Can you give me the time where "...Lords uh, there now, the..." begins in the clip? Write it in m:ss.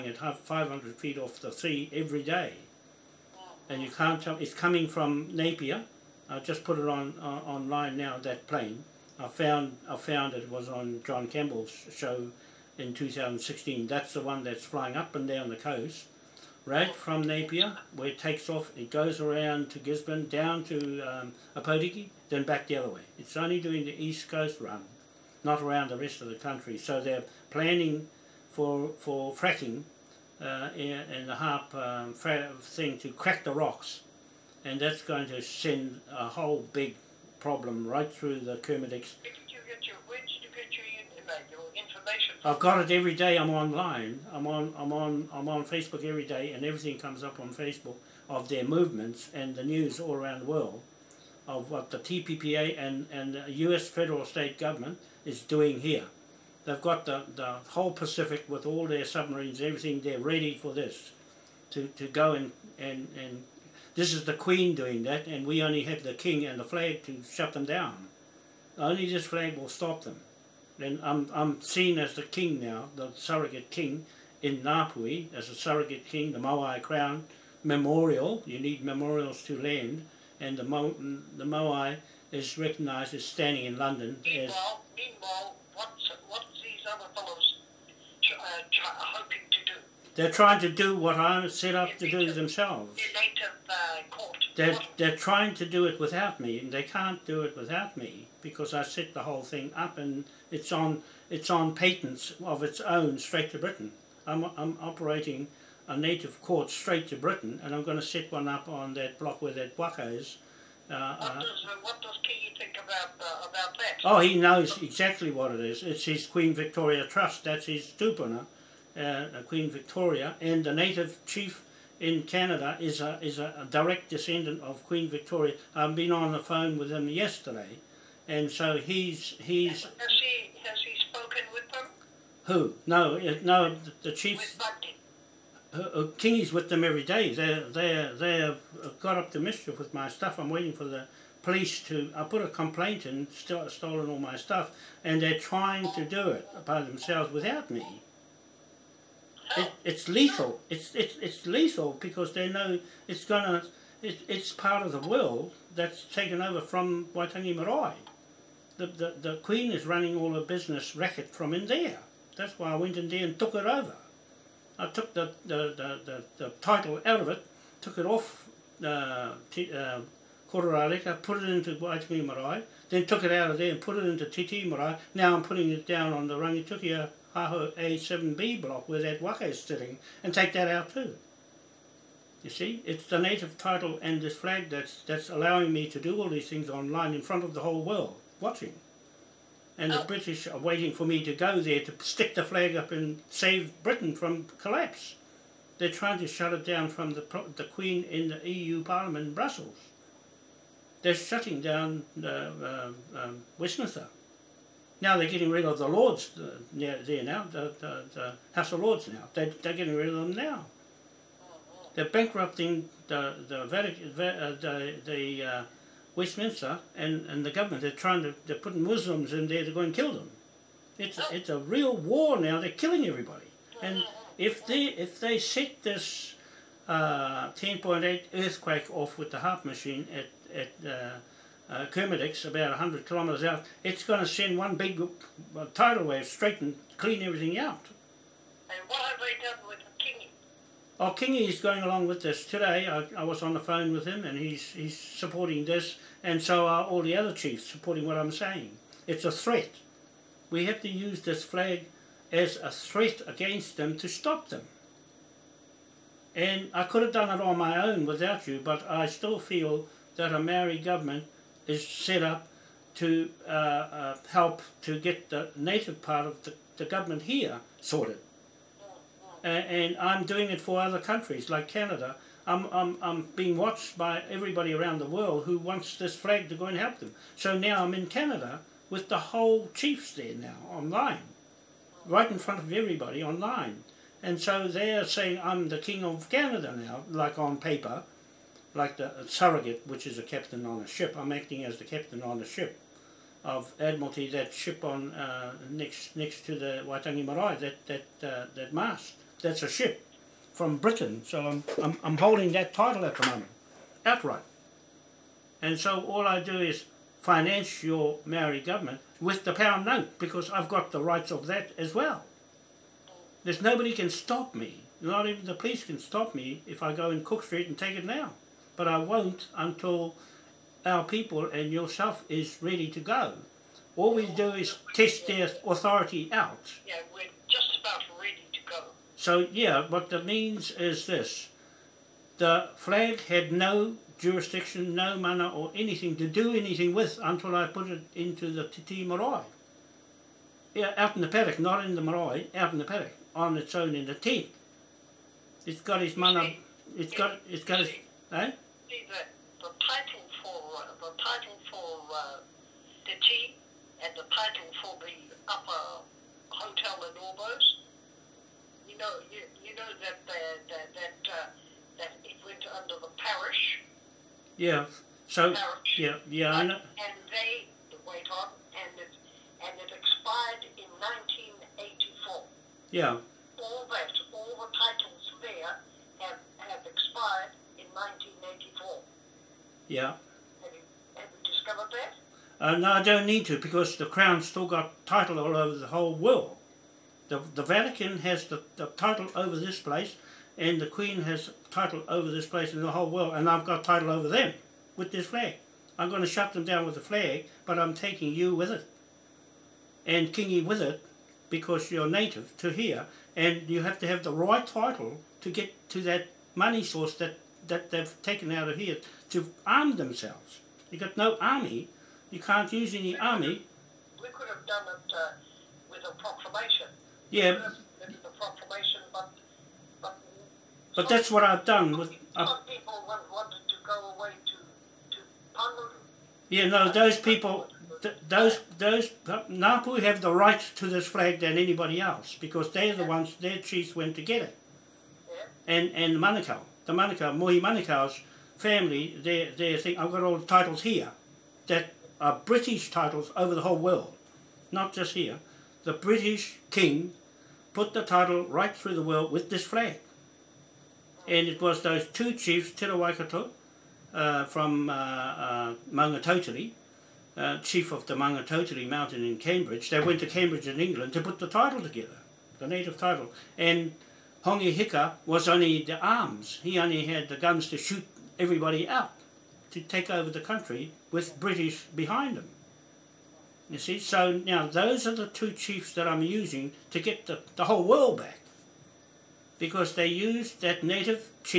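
3:25.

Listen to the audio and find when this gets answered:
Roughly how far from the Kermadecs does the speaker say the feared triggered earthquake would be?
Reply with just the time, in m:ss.
3:52.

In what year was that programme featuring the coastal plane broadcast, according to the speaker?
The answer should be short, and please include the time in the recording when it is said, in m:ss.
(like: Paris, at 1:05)
2016, at 0:12.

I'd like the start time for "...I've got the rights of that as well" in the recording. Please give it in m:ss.
5:10.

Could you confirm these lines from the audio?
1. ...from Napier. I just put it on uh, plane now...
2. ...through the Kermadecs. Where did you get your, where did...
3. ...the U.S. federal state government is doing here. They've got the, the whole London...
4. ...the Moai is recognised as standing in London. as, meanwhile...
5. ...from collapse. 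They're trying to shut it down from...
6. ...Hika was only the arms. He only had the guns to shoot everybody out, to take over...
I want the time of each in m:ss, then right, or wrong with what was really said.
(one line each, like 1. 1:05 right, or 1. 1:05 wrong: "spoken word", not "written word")
1. 0:04 wrong: "online", not "plane"
2. 0:38 right
3. 0:53 wrong: "Pacific", not "London"
4. 1:20 right
5. 3:14 right
6. 7:44 right.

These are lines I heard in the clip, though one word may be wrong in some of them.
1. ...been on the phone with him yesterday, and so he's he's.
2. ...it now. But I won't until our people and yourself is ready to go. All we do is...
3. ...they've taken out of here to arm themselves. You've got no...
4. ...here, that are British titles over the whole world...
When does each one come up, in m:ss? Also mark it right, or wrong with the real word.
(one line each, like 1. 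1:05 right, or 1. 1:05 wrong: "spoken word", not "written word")
1. 2:05 right
2. 5:17 right
3. 6:47 right
4. 7:20 right.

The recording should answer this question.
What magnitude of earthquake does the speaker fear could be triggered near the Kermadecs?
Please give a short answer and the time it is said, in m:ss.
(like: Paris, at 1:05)
10.8, at 3:46.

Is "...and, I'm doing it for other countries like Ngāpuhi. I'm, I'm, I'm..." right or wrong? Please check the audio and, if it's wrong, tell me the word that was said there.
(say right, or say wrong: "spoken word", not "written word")
wrong: "Canada", not "Ngāpuhi".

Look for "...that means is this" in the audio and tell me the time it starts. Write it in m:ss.
5:30.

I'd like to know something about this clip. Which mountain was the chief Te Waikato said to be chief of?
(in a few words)
Maungatautari.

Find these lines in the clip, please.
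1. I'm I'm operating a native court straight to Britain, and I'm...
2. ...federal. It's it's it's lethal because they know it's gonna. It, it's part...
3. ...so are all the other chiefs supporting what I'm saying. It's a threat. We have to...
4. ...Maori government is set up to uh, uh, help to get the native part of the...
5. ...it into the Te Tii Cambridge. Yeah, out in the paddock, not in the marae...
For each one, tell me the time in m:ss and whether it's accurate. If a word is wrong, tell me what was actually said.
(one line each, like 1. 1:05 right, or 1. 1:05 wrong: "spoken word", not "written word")
1. 1:44 right
2. 2:30 wrong: "lethal", not "federal"
3. 4:06 right
4. 4:20 right
5. 5:37 wrong: "Marae", not "Cambridge".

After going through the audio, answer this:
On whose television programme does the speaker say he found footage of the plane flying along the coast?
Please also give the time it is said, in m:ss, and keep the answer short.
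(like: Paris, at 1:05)
John Campbell, at 0:11.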